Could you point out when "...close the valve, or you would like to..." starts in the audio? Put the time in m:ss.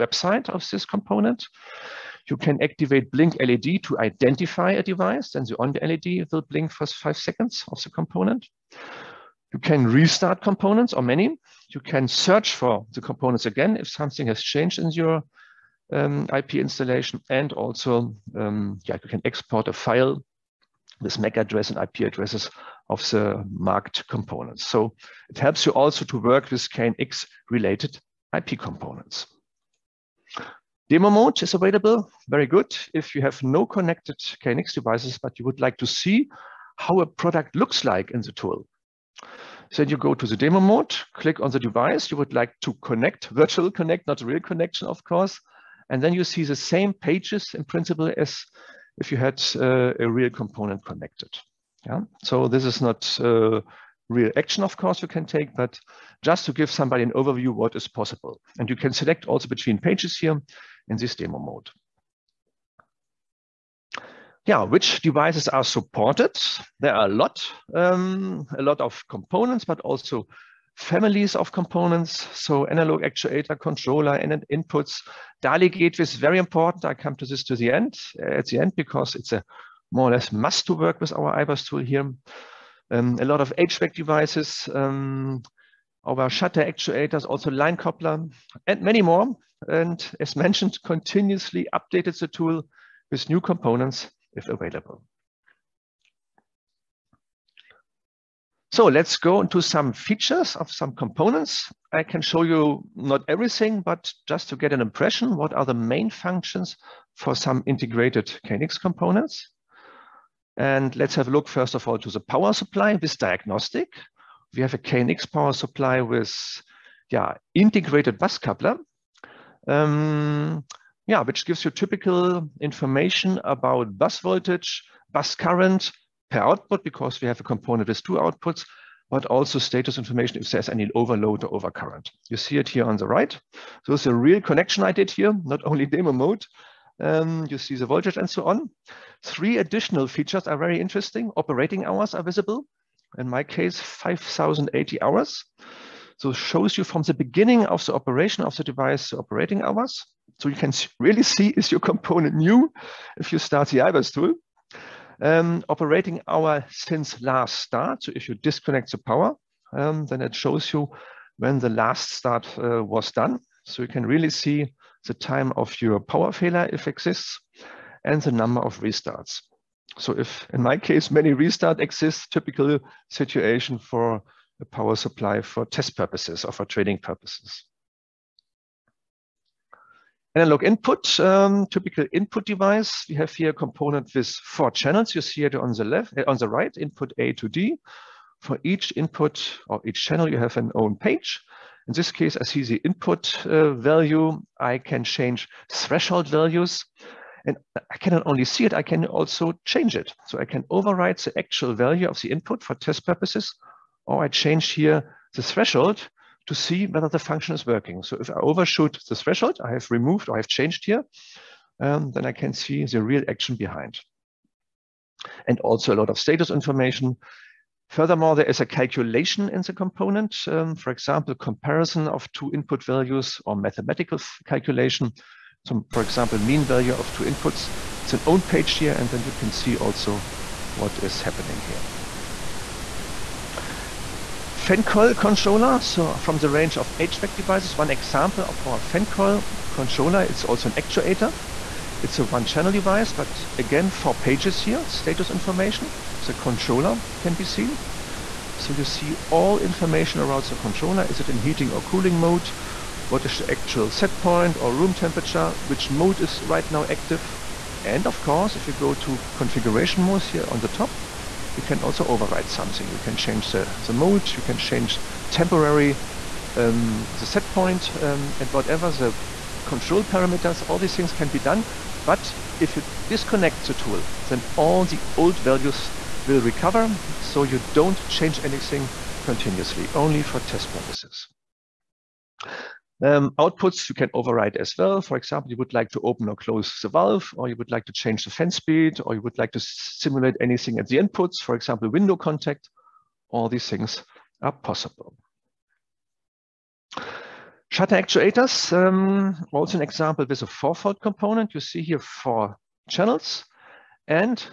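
4:46.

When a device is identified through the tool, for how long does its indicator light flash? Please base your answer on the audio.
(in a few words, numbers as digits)
5 seconds.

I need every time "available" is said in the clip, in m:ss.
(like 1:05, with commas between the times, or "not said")
0:31, 1:34.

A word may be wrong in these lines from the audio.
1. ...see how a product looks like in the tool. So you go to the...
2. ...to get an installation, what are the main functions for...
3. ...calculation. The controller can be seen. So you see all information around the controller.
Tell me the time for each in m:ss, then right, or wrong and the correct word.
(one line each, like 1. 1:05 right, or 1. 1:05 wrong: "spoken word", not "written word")
1. 0:35 right
2. 1:44 wrong: "impression", not "installation"
3. 4:05 wrong: "information", not "calculation".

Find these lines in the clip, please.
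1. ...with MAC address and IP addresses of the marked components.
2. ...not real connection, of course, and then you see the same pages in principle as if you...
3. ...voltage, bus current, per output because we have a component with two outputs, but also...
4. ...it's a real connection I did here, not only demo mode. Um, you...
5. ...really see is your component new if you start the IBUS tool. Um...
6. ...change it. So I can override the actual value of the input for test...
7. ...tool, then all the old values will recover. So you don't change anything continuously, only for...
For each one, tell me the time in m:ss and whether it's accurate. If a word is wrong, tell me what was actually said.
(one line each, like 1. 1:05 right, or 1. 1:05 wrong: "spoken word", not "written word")
1. 0:21 right
2. 0:44 right
3. 2:04 right
4. 2:13 right
5. 2:30 right
6. 3:19 right
7. 4:33 right.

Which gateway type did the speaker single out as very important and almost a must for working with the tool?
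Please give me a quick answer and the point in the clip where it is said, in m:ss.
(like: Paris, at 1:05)
DALI gateway, at 1:15.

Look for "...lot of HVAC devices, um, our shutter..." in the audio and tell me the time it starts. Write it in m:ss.
1:23.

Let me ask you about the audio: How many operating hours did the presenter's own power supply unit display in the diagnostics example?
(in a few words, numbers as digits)
5,080.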